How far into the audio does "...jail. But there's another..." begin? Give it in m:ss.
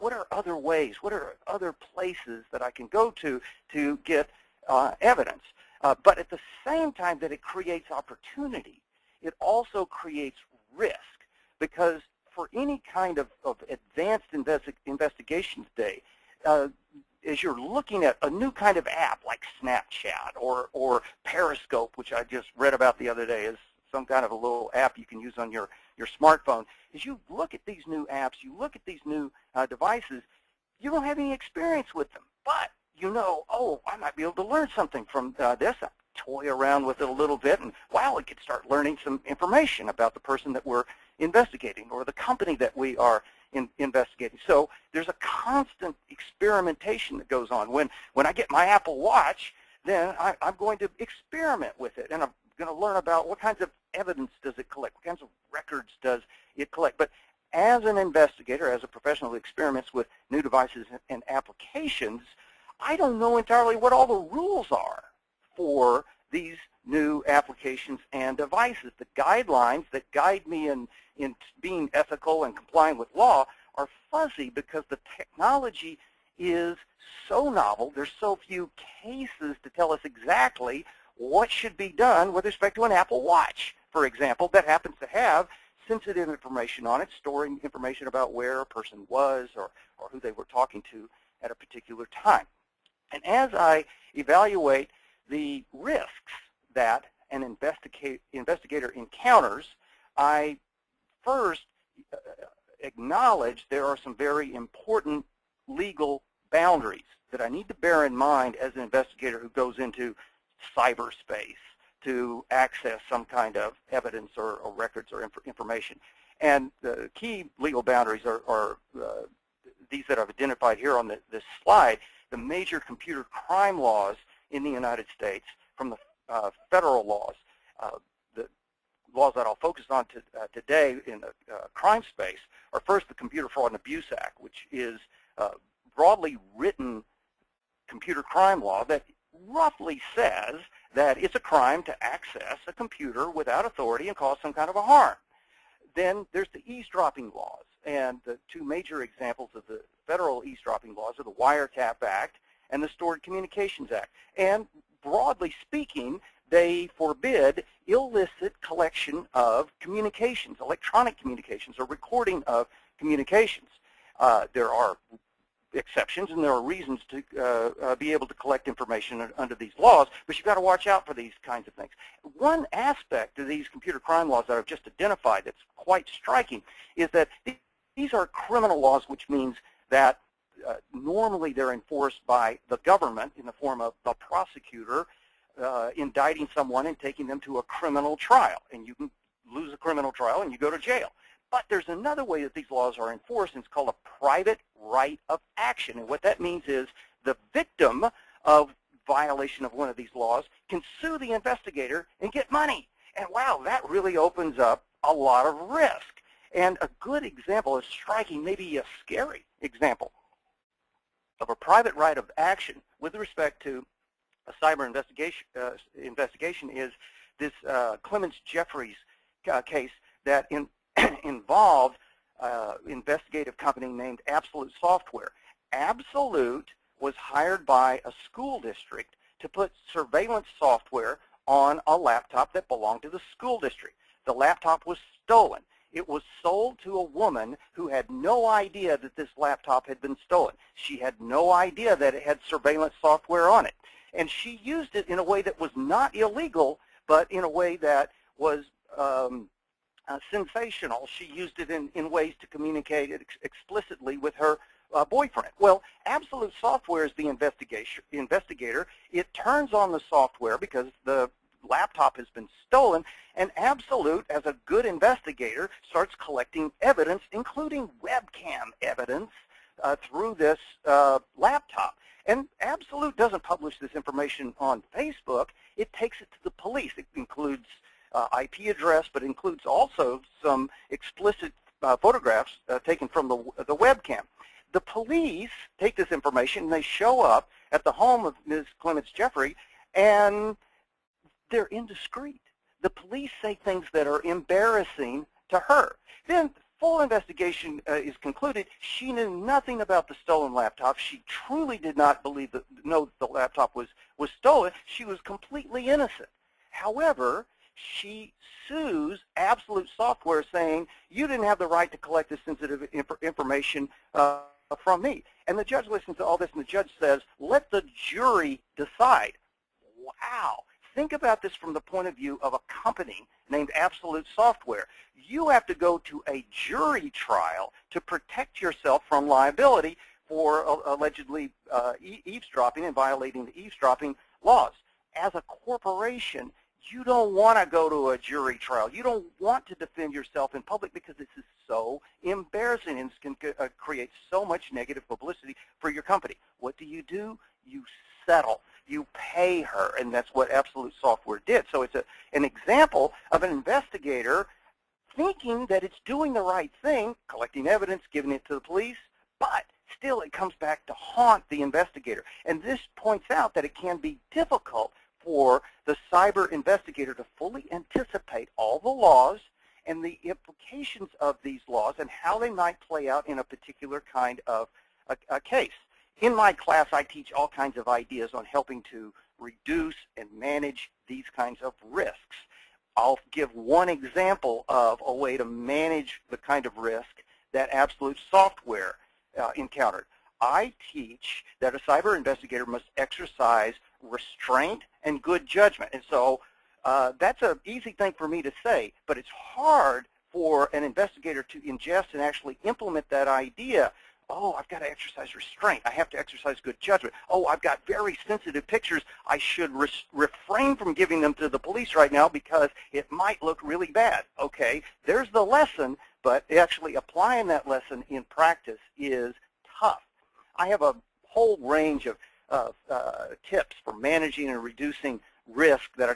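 3:10.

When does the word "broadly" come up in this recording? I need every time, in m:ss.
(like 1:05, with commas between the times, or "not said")
2:15, 2:35.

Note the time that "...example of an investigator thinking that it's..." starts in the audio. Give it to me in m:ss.
5:52.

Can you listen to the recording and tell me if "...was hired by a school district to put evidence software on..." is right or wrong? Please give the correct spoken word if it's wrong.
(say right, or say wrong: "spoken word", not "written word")
wrong: "surveillance", not "evidence".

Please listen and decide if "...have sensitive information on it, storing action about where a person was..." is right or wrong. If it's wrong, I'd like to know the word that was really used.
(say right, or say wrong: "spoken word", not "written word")
wrong: "information", not "action".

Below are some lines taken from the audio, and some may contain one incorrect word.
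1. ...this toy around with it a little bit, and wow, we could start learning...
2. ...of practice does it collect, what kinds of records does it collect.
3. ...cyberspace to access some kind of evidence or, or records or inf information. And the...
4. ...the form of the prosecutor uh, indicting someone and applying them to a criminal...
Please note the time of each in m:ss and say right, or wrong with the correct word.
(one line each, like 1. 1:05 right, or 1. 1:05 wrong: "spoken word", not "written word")
1. 0:35 right
2. 0:53 wrong: "evidence", not "practice"
3. 1:50 right
4. 3:03 wrong: "taking", not "applying".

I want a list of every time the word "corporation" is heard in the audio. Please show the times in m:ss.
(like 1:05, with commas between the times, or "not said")
5:35.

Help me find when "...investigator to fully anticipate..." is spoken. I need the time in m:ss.
6:06.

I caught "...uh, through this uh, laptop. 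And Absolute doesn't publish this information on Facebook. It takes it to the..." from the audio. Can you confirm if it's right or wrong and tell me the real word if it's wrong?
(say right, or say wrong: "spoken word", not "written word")
right.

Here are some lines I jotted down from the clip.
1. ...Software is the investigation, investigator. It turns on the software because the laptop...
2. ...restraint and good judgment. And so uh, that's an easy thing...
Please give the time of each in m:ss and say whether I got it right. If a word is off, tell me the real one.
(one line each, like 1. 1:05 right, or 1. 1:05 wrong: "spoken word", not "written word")
1. 4:16 right
2. 6:34 right.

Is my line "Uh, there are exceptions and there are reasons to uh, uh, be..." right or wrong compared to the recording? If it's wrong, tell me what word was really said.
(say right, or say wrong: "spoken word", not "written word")
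right.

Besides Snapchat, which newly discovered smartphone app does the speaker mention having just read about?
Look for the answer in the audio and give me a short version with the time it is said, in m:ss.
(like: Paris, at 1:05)
Periscope, at 0:21.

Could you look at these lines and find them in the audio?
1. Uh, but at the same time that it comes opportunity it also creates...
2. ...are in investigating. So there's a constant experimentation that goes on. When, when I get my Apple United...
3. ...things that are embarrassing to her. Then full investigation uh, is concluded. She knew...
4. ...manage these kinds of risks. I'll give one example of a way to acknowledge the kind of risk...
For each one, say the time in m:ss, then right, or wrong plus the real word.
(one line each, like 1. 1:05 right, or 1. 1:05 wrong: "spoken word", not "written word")
1. 0:05 wrong: "creates", not "comes"
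2. 0:42 wrong: "Watch", not "United"
3. 4:53 right
4. 6:20 wrong: "manage", not "acknowledge".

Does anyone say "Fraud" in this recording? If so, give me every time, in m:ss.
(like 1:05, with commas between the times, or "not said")
2:13.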